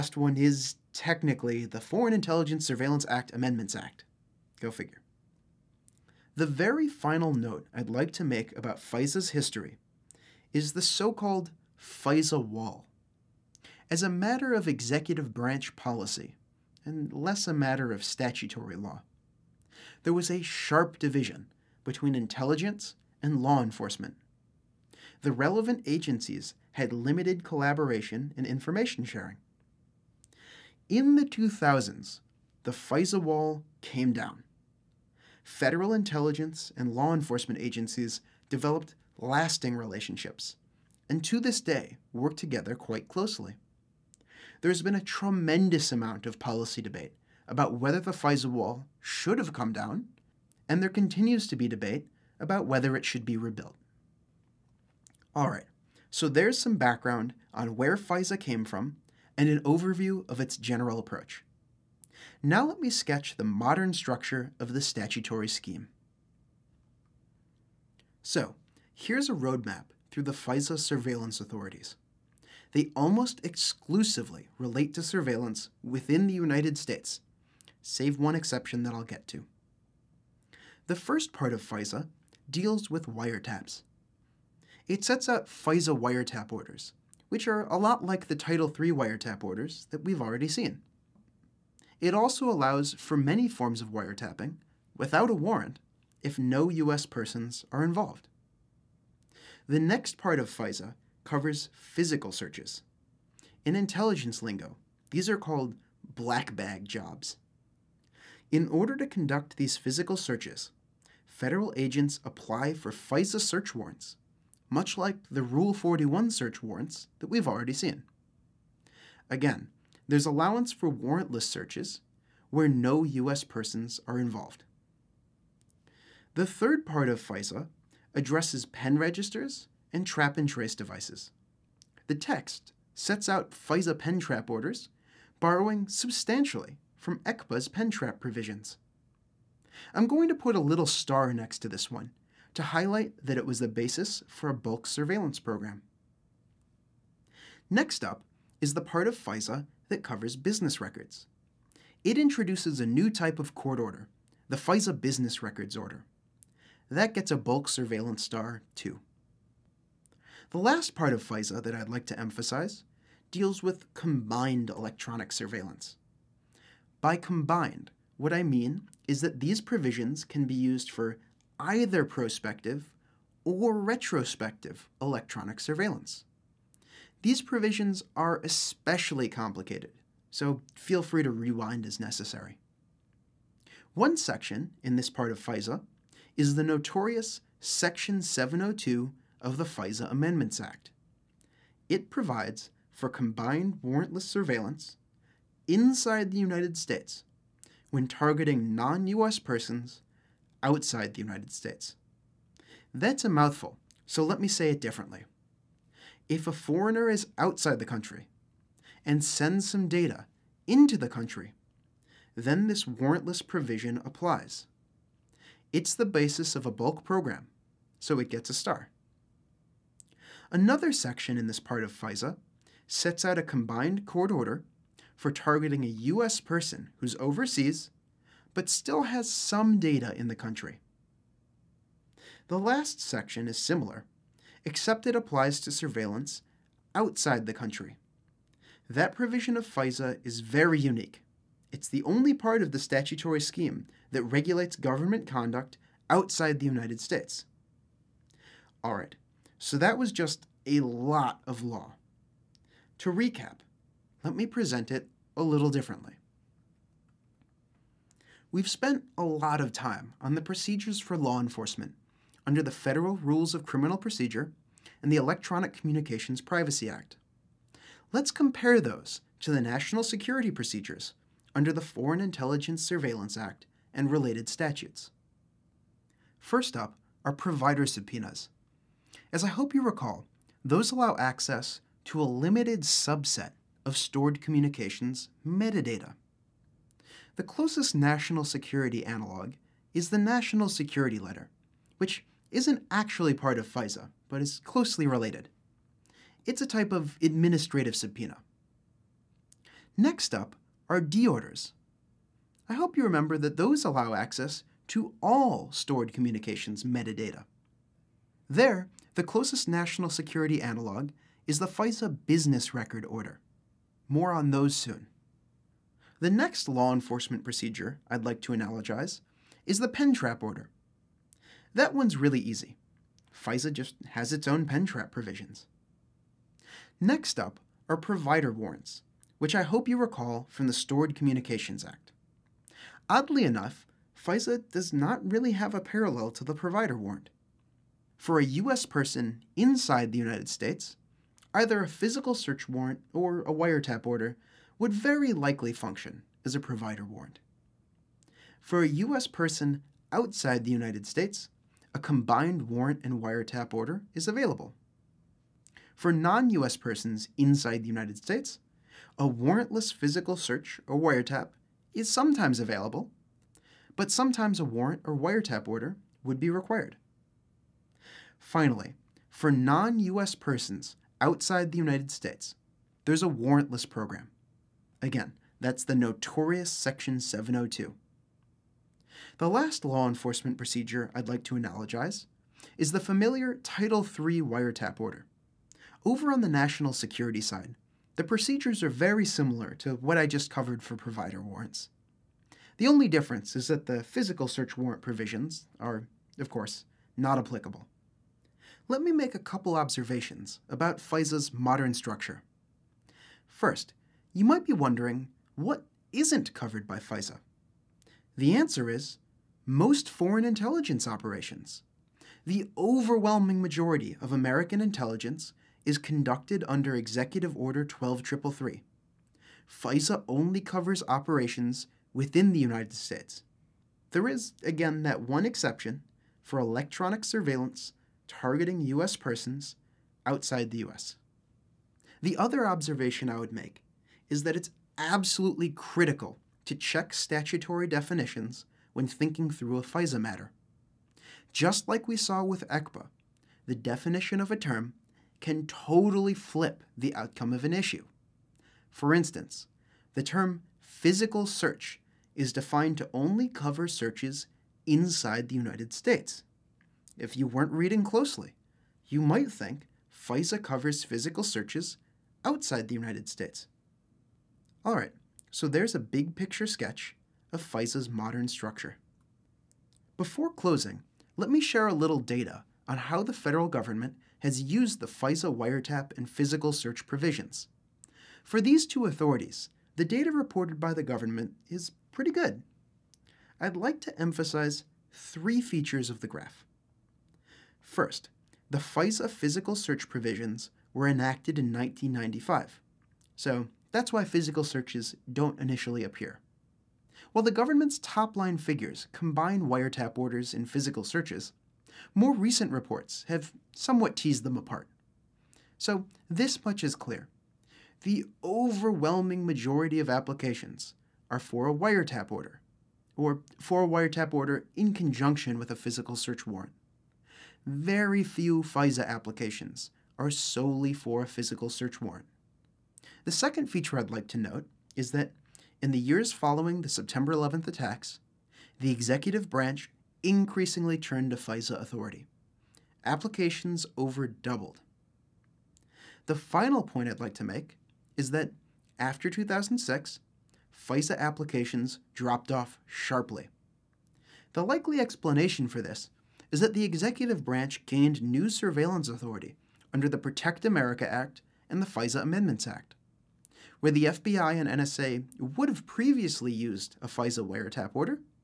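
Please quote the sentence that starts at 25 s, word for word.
The relevant agencies had limited collaboration and information sharing.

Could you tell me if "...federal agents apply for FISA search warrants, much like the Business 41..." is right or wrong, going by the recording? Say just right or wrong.
wrong.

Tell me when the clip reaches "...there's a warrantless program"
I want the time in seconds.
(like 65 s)
373 s.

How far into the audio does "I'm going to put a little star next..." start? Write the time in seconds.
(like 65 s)
139 s.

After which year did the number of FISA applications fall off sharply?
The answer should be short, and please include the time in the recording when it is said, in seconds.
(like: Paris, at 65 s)
2006, at 539 s.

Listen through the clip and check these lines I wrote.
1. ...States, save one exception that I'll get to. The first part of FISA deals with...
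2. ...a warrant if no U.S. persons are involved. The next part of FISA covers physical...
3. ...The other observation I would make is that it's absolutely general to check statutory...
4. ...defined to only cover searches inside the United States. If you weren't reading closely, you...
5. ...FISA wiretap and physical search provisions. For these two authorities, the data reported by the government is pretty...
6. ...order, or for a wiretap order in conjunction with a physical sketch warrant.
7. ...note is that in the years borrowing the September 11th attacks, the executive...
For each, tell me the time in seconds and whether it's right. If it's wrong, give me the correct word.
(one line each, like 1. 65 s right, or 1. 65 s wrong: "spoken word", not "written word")
1. 76 s right
2. 95 s right
3. 432 s wrong: "critical", not "general"
4. 452 s right
5. 475 s right
6. 512 s wrong: "search", not "sketch"
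7. 524 s wrong: "following", not "borrowing".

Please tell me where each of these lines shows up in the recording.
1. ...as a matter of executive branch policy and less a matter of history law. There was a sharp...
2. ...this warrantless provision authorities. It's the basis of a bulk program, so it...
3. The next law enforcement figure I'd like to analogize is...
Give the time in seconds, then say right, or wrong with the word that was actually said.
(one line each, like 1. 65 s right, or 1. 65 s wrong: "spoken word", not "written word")
1. 13 s wrong: "statutory", not "history"
2. 212 s wrong: "applies", not "authorities"
3. 316 s wrong: "procedure", not "figure".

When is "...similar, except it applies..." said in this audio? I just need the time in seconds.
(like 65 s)
233 s.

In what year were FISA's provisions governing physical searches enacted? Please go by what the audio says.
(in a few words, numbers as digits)
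1995.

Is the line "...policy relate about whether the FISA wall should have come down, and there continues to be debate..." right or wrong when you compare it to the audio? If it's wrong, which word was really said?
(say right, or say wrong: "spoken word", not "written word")
wrong: "debate", not "relate".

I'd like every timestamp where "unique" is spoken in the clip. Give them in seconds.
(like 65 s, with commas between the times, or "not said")
240 s.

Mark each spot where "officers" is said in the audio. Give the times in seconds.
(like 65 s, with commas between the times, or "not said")
not said.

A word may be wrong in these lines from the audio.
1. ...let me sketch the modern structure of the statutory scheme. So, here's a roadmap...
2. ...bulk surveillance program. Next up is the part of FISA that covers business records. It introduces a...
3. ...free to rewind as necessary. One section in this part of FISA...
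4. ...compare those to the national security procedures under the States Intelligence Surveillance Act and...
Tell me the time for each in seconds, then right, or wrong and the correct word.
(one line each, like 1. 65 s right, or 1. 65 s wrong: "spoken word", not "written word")
1. 62 s right
2. 144 s right
3. 181 s right
4. 268 s wrong: "Foreign", not "States".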